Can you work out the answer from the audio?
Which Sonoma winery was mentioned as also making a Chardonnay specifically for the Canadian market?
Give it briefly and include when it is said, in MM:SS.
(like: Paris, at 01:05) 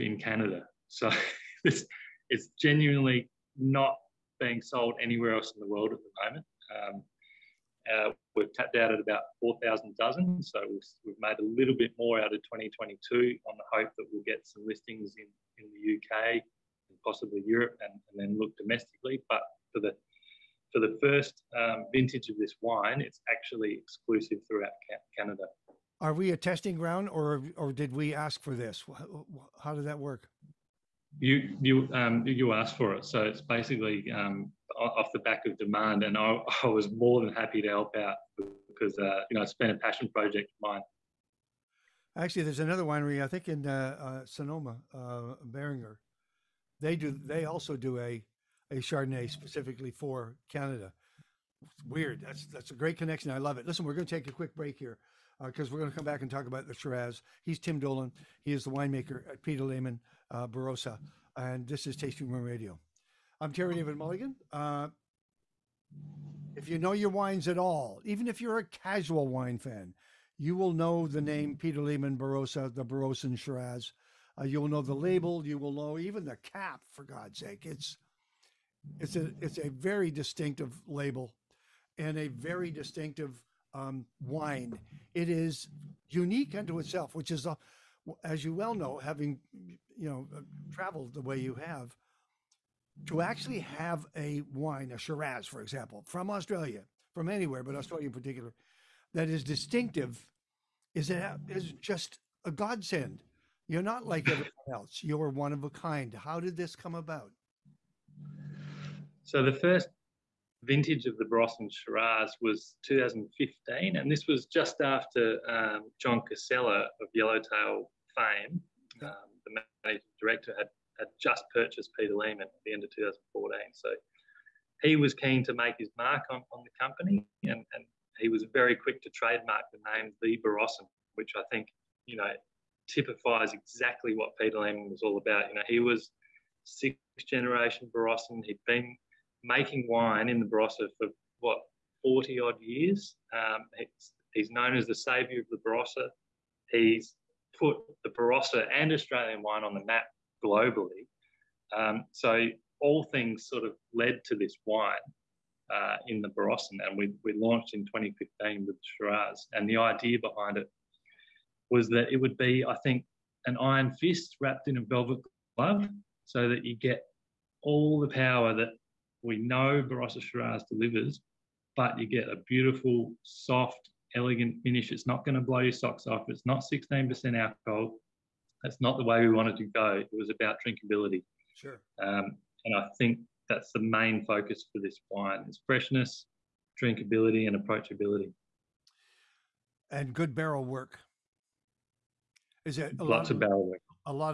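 Beringer, at 00:45.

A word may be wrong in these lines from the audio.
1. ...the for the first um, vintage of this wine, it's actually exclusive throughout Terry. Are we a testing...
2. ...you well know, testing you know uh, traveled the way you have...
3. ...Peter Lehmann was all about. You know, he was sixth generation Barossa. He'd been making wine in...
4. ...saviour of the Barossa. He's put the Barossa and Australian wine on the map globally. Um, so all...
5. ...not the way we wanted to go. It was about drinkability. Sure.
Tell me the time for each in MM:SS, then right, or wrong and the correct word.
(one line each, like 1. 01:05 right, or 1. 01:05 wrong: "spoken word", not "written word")
1. 00:19 wrong: "Canada", not "Terry"
2. 01:28 wrong: "having", not "testing"
3. 02:14 right
4. 02:24 right
5. 02:58 right.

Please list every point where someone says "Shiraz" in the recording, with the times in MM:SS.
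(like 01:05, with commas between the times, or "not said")
00:56, 01:13, 01:34, 01:51, 02:38, 02:50.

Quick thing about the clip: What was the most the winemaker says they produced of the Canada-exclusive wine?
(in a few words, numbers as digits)
4,000 dozen.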